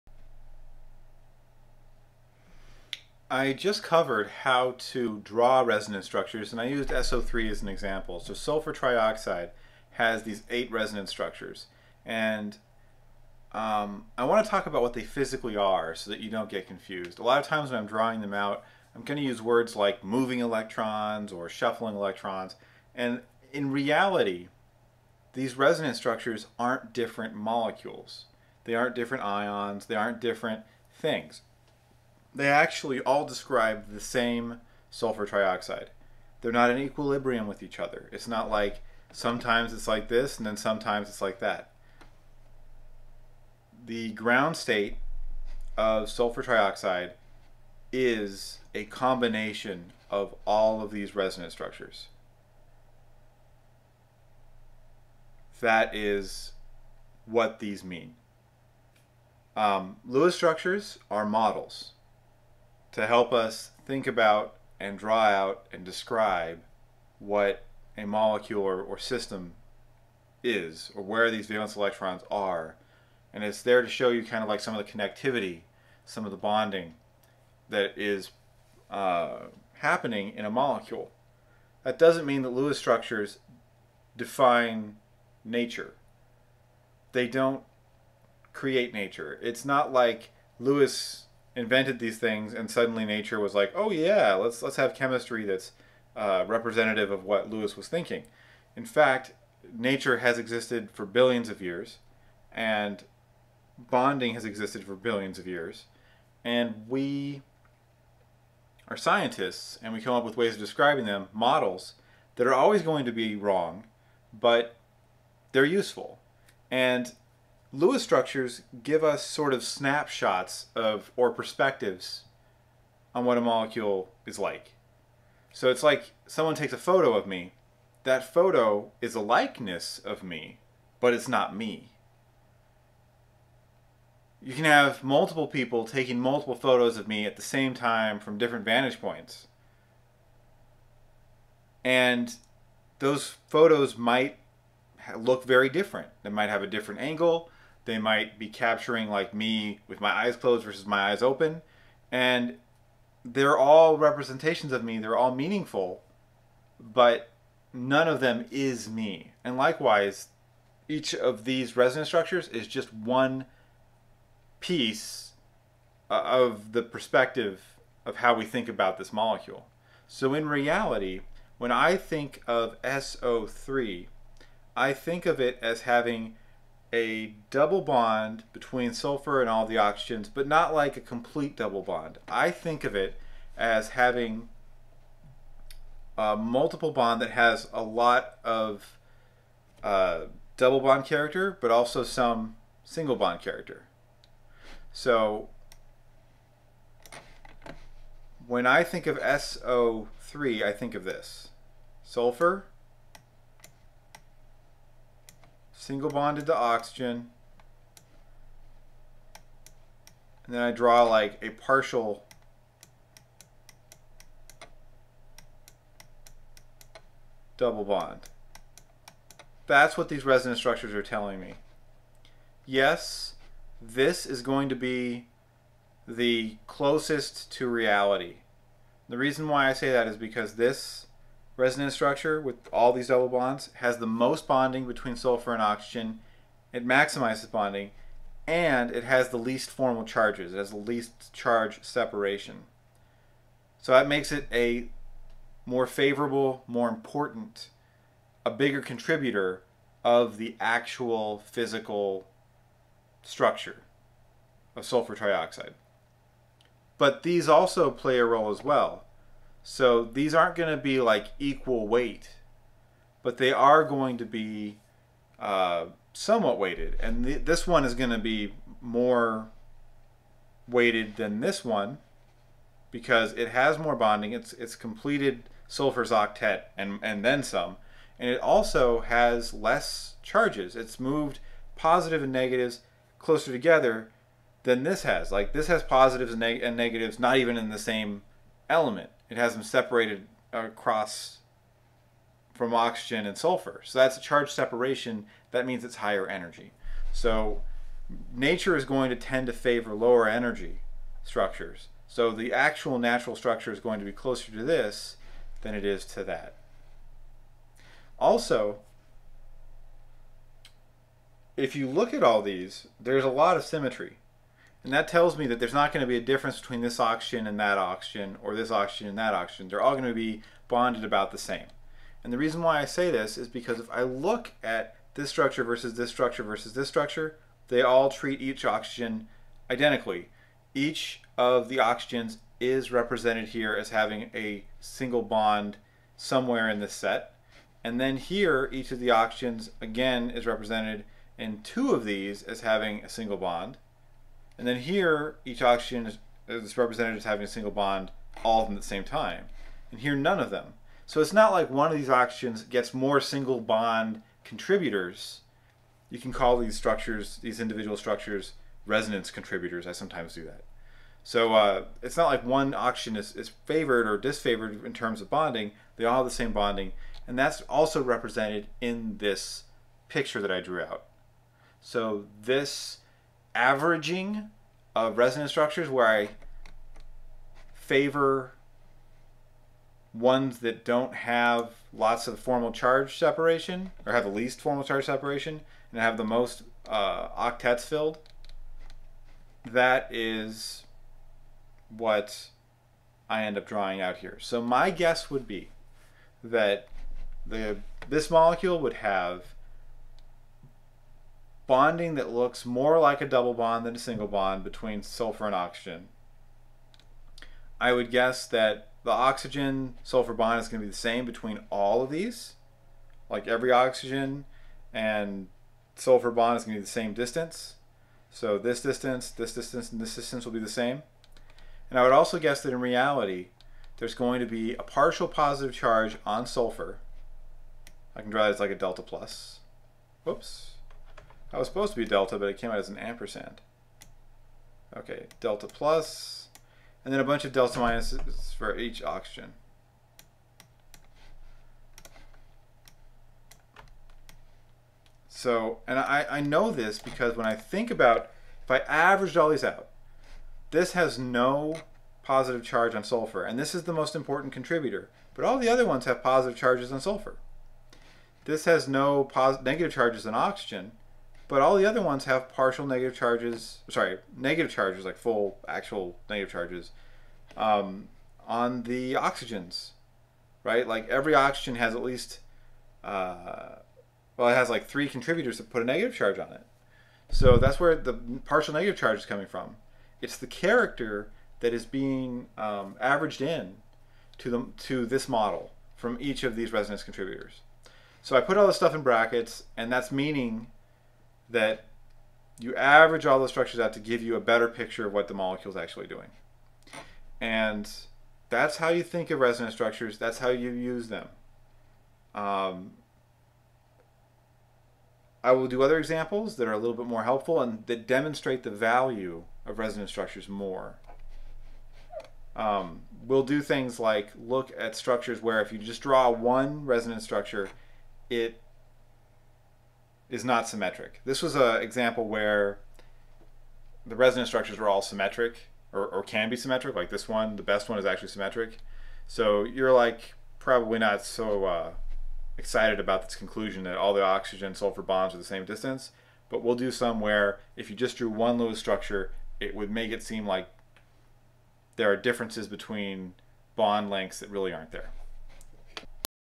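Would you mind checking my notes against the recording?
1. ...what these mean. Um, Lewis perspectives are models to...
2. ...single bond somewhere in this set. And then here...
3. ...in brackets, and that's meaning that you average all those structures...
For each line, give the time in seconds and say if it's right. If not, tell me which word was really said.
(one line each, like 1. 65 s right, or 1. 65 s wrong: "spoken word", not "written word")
1. 57 s wrong: "structures", not "perspectives"
2. 334 s right
3. 488 s right.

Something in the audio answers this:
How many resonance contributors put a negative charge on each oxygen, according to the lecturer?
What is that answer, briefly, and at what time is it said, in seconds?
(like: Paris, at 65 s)
3, at 474 s.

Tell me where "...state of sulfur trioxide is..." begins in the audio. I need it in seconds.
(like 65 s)
44 s.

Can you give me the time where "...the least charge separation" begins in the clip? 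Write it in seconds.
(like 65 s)
240 s.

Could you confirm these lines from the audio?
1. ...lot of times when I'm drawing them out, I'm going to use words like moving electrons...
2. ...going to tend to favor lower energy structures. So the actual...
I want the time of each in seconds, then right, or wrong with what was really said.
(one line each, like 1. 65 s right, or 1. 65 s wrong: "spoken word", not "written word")
1. 17 s right
2. 298 s right.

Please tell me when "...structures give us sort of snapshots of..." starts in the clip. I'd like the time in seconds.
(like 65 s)
118 s.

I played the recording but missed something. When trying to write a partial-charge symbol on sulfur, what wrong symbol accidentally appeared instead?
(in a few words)
An ampersand.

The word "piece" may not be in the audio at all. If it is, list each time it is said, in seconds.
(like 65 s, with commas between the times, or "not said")
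164 s.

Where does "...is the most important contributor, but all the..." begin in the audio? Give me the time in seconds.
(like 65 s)
453 s.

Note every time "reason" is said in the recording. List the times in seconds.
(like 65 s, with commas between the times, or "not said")
229 s, 322 s.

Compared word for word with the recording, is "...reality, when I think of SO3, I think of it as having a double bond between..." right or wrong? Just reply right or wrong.
right.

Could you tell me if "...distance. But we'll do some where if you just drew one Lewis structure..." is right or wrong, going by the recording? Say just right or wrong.
right.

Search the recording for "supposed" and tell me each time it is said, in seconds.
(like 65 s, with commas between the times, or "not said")
431 s.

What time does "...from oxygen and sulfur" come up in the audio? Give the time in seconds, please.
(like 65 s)
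292 s.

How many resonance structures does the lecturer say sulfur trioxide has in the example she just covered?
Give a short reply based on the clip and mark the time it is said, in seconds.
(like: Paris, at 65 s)
8, at 10 s.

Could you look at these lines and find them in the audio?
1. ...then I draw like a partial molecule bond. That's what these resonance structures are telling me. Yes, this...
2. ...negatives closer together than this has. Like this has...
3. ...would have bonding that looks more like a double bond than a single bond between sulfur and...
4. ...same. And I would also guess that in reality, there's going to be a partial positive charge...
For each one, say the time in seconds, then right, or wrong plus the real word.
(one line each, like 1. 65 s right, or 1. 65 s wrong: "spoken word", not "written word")
1. 210 s wrong: "double", not "molecule"
2. 282 s right
3. 398 s right
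4. 420 s right.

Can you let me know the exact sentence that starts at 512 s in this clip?
Um, we'll do things like look at structures where if you just draw one resonance structure, it is not symmetric.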